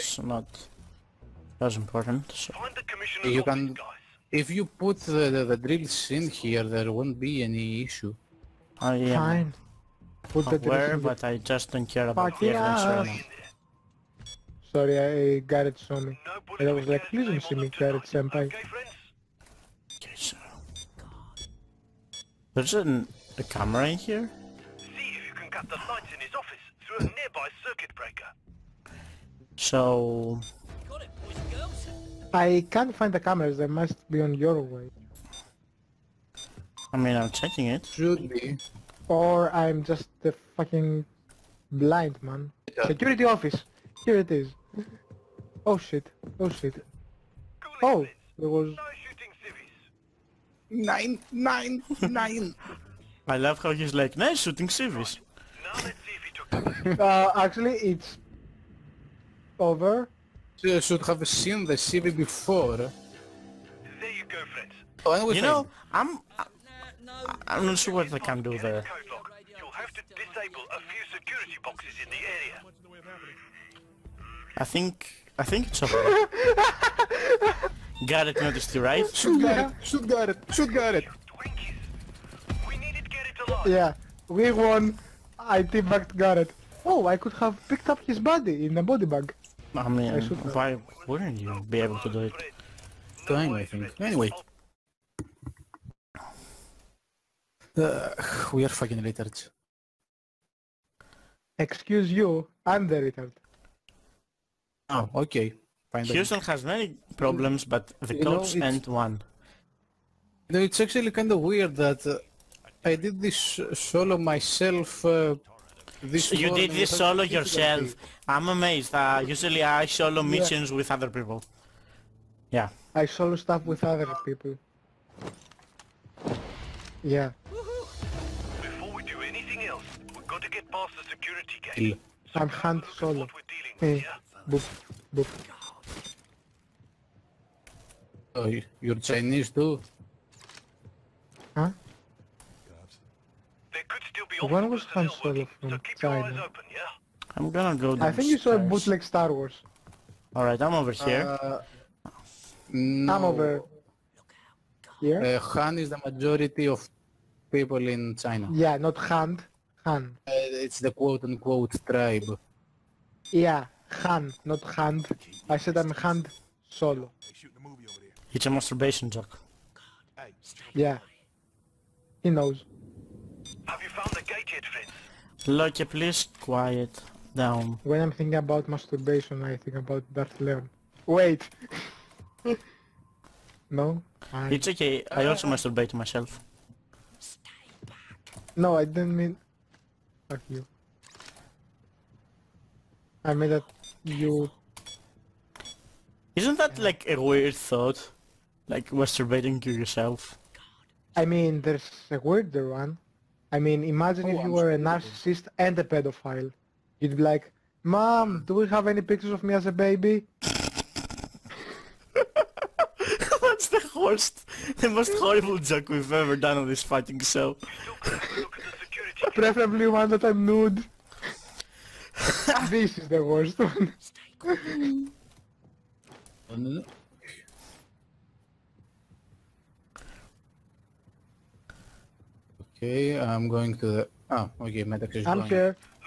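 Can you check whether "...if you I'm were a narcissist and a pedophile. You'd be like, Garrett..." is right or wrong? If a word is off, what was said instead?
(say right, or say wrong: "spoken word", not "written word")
wrong: "Mom", not "Garrett".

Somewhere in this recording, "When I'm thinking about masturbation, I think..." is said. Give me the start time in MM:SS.
02:57.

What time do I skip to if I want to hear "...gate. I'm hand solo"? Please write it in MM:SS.
02:11.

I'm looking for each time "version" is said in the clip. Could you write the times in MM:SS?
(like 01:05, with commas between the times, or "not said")
not said.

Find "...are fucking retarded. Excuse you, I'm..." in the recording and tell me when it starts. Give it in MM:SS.
01:38.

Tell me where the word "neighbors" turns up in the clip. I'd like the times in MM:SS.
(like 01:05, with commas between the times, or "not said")
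not said.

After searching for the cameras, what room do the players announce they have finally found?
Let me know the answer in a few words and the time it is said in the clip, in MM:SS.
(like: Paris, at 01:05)
Security office, at 00:42.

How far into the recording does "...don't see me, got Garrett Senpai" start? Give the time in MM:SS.
00:17.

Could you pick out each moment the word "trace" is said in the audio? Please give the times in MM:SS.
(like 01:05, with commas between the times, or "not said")
not said.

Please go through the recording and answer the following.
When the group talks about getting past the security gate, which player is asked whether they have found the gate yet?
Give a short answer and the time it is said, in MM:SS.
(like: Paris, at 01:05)
Fritz, at 02:54.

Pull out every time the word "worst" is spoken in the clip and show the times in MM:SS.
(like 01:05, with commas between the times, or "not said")
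03:33, 03:43.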